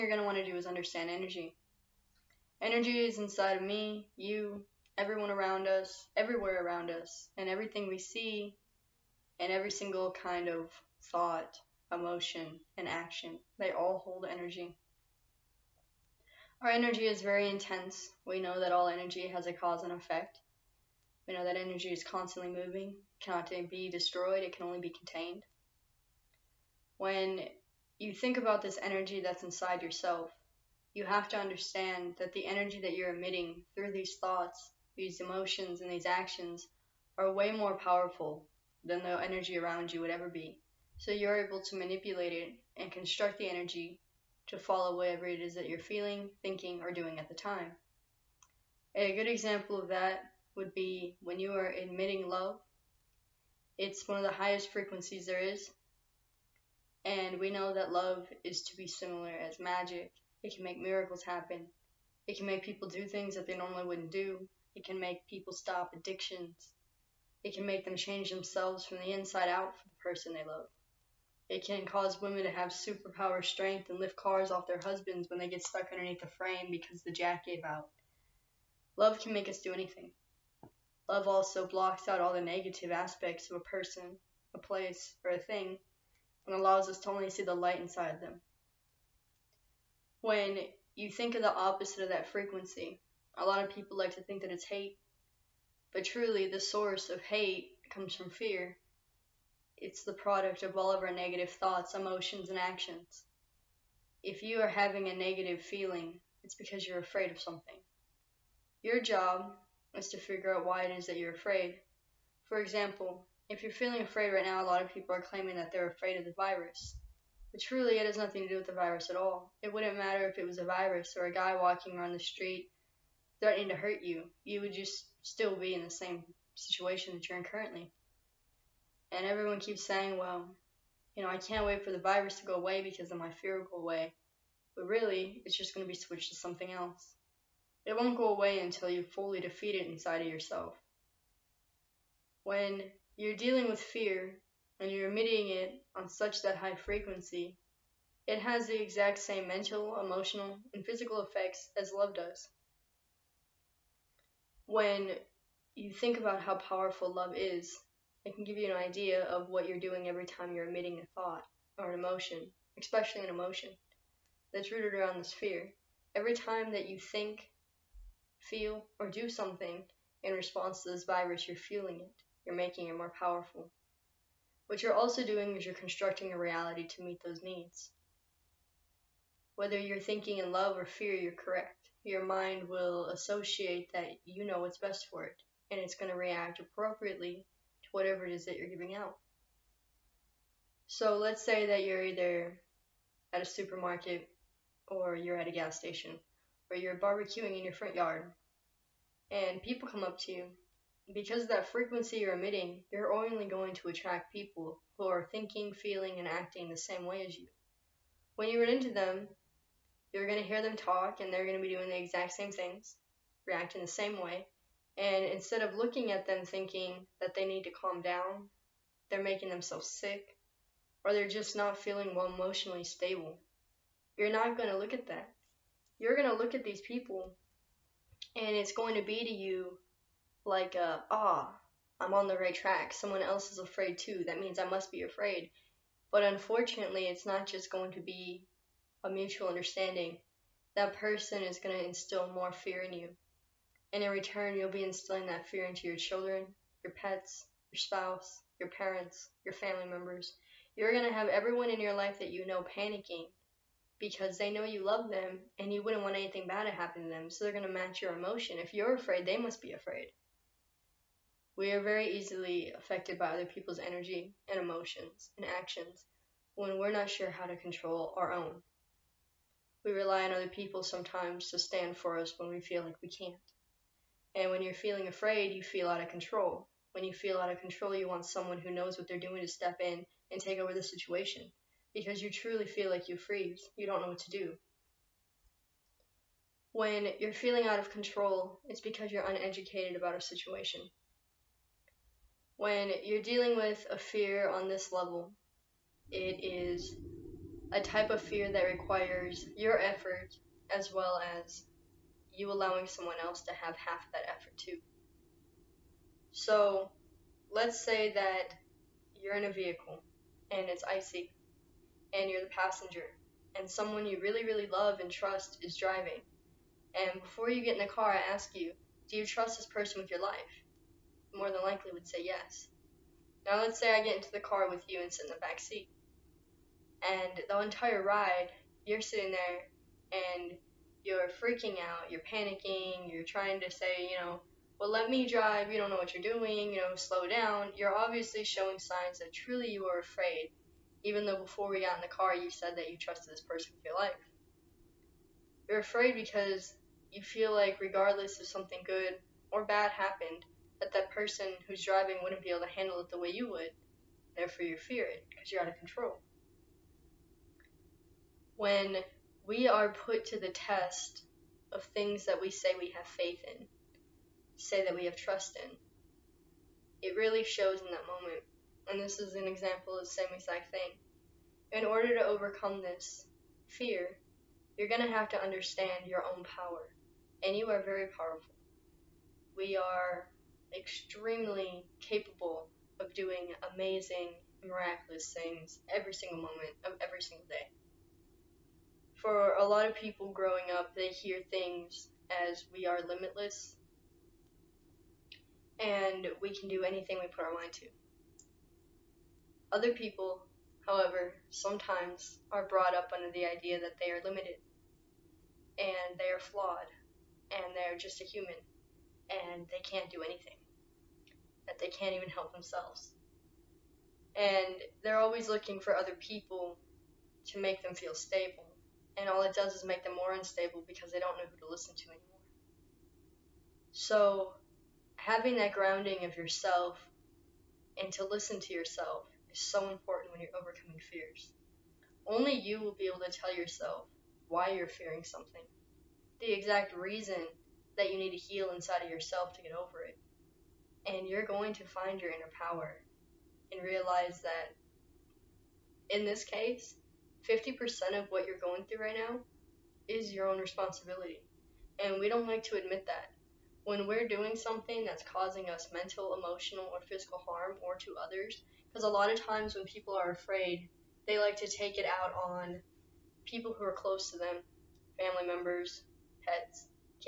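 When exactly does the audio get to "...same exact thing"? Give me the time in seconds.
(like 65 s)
370 s.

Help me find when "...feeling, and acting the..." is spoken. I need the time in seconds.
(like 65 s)
205 s.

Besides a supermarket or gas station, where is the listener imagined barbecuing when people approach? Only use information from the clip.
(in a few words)
front yard.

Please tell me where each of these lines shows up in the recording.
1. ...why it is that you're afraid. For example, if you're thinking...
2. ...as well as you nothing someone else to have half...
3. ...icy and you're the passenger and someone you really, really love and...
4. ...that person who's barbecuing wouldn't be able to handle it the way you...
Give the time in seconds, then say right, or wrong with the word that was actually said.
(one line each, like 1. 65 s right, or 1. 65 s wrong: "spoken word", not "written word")
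1. 110 s wrong: "feeling", not "thinking"
2. 300 s wrong: "allowing", not "nothing"
3. 310 s right
4. 350 s wrong: "driving", not "barbecuing".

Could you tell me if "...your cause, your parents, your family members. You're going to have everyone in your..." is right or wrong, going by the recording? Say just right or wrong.
wrong.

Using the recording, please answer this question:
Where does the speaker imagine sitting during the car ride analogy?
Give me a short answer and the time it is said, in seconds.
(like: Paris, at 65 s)
back seat, at 325 s.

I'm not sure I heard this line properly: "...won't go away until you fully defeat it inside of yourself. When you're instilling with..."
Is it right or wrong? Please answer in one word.
wrong.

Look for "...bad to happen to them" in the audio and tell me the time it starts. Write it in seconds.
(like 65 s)
256 s.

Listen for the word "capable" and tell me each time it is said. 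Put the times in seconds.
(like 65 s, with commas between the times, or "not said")
381 s.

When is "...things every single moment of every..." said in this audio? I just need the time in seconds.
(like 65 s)
385 s.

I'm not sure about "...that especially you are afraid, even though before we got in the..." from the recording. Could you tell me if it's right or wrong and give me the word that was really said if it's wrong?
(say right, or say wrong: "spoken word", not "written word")
wrong: "truly", not "especially".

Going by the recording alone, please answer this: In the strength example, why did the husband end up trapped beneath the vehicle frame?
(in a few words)
The jack gave out.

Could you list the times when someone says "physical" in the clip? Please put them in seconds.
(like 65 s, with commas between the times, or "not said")
150 s, 457 s.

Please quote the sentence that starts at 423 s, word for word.
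So, having that grounding of yourself and to listen to yourself is so important when you're overcoming fears.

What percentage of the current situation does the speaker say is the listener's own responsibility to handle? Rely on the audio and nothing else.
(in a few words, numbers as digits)
50%.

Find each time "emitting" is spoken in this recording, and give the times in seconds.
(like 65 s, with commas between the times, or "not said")
33 s, 145 s, 160 s, 202 s.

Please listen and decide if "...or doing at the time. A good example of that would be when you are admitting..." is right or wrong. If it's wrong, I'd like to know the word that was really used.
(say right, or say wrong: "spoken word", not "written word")
right.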